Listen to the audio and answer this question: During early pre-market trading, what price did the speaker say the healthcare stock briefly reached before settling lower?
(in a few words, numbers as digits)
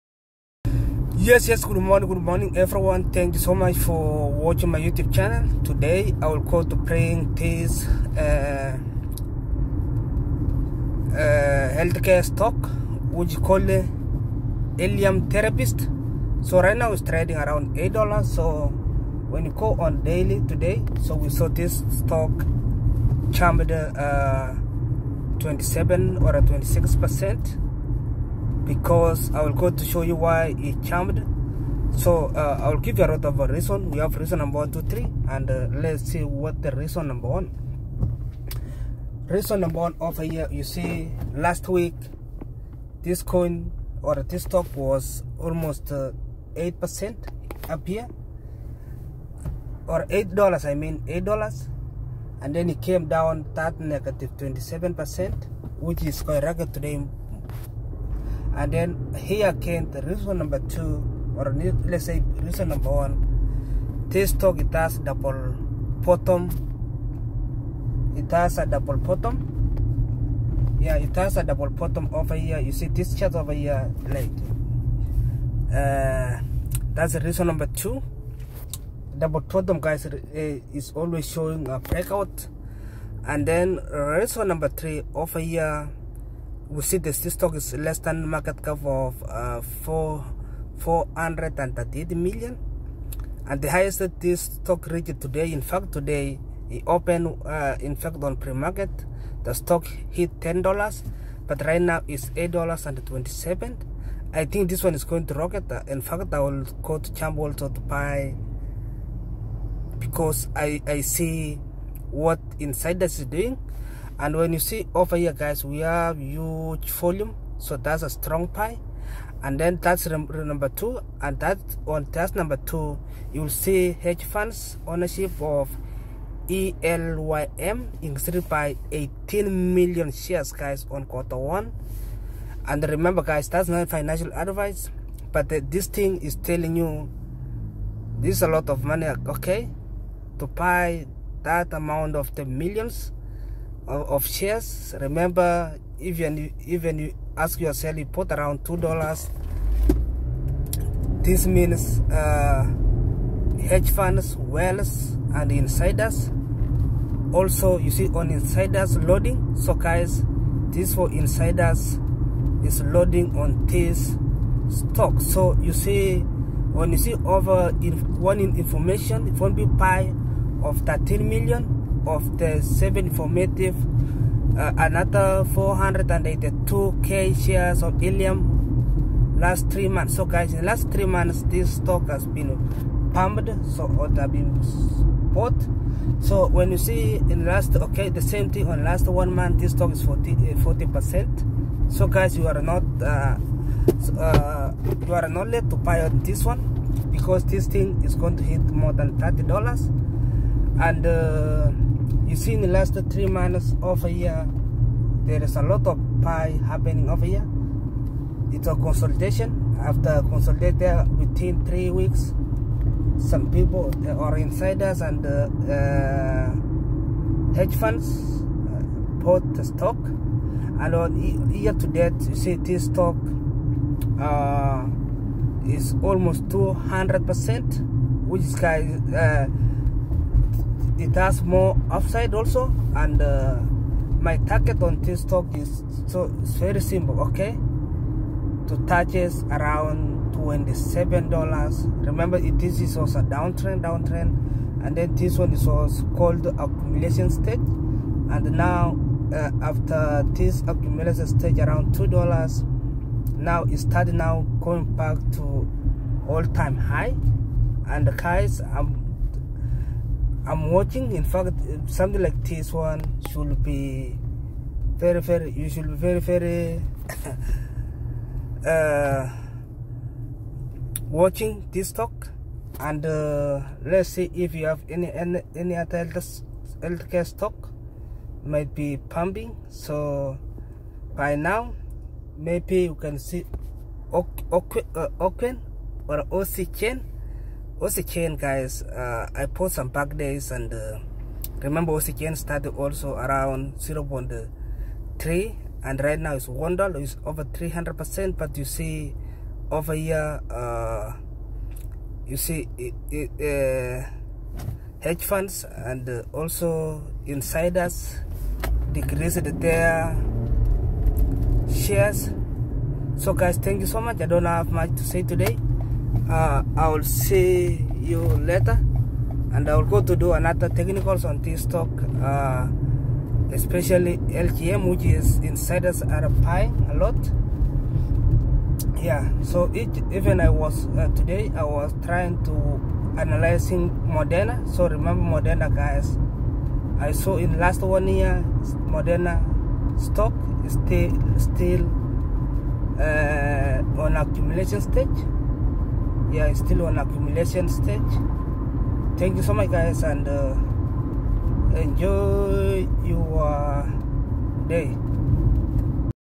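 $10.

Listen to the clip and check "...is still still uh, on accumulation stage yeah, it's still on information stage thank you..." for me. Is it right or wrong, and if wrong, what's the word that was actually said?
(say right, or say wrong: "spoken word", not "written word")
wrong: "accumulation", not "information".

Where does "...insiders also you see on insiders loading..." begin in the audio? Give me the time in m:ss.
2:35.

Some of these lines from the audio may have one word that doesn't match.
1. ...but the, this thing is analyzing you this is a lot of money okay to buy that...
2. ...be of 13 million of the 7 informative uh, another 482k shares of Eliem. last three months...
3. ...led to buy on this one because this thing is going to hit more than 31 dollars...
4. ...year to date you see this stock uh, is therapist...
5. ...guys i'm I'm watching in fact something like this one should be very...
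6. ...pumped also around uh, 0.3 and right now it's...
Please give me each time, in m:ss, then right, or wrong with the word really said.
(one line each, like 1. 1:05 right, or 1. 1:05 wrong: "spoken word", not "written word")
1. 2:15 wrong: "telling", not "analyzing"
2. 2:49 right
3. 3:15 wrong: "30", not "31"
4. 3:41 wrong: "almost", not "therapist"
5. 4:18 right
6. 4:52 wrong: "started", not "pumped".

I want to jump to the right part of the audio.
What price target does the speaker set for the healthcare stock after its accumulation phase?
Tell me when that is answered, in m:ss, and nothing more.
4:00.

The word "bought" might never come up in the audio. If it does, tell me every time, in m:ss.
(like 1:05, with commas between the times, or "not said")
3:05, 3:39.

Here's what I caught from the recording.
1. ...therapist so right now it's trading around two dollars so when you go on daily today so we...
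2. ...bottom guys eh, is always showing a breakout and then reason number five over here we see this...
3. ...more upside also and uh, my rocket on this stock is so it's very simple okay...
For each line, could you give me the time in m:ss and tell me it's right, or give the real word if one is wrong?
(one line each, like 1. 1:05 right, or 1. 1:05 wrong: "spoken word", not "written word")
1. 0:15 wrong: "eight", not "two"
2. 1:19 wrong: "three", not "five"
3. 3:51 wrong: "target", not "rocket".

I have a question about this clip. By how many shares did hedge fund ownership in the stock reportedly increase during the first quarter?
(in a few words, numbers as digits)
18 million.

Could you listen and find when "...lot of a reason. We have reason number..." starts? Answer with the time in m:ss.
0:33.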